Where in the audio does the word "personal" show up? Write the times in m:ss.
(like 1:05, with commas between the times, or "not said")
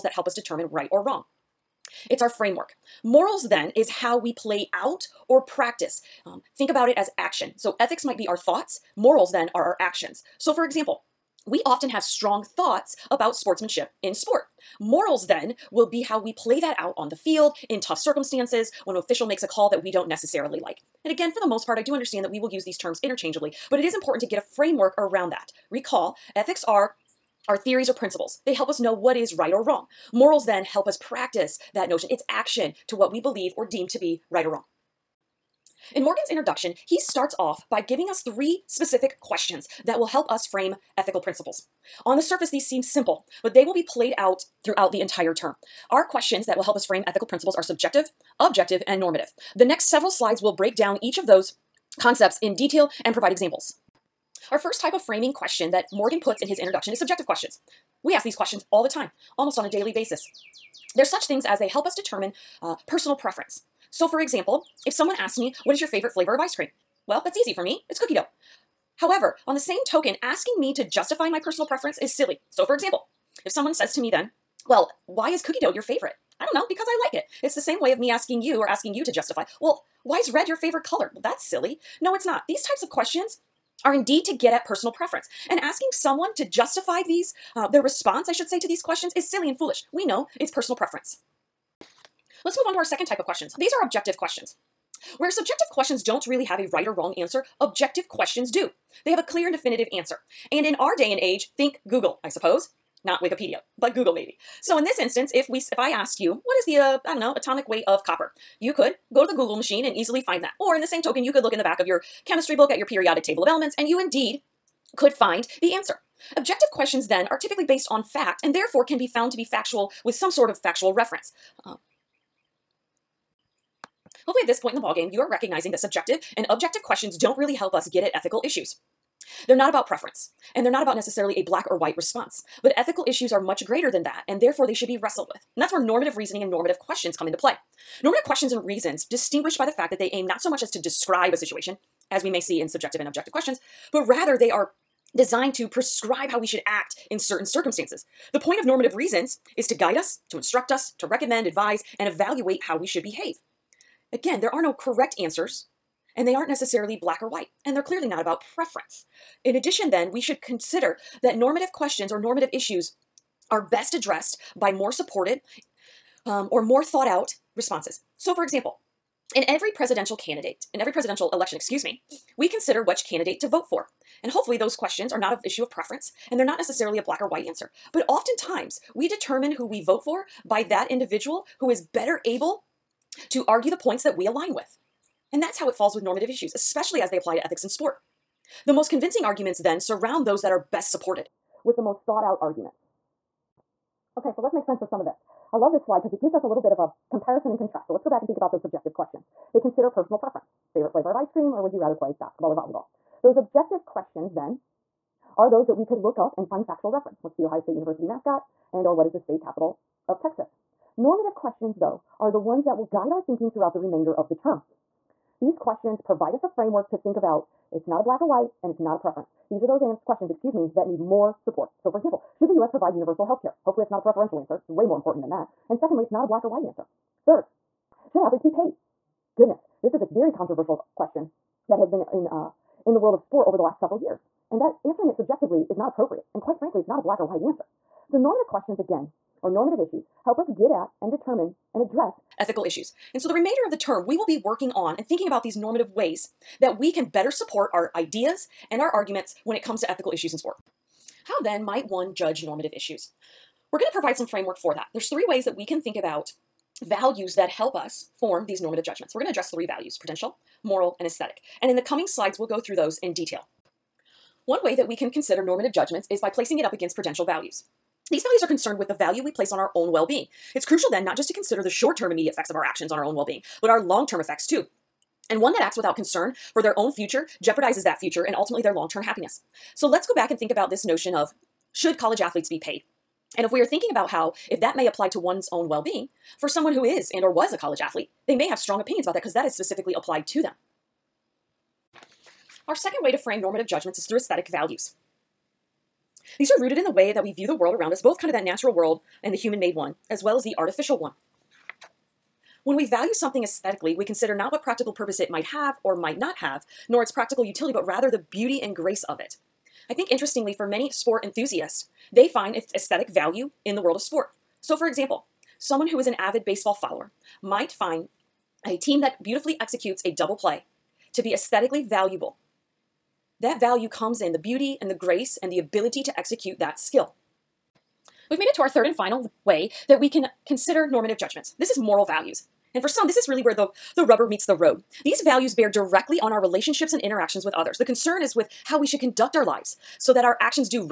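1:02, 1:11, 1:24, 1:30, 3:19.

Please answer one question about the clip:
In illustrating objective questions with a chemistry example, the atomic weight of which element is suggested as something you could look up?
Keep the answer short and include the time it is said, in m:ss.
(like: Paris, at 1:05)
Copper, at 1:48.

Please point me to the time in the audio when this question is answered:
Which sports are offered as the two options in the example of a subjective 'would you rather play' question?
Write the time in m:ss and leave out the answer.
3:22.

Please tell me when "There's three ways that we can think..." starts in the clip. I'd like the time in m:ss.
4:14.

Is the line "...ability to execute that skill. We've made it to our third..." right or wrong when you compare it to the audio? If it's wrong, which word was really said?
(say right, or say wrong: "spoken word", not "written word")
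right.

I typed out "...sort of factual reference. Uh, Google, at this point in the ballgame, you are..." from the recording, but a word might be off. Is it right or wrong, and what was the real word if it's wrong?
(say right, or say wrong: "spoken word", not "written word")
wrong: "Hopefully", not "Google".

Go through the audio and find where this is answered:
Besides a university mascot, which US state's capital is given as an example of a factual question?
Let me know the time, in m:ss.
3:30.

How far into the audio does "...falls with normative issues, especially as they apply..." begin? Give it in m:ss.
3:05.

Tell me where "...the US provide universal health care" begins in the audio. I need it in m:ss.
3:42.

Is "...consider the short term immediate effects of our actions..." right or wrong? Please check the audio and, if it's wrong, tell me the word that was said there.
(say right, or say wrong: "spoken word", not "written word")
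right.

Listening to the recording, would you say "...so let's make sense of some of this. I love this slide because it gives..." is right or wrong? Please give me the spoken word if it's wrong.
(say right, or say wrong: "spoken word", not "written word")
right.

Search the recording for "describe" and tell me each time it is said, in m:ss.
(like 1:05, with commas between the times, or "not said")
2:20.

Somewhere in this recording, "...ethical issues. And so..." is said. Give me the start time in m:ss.
4:02.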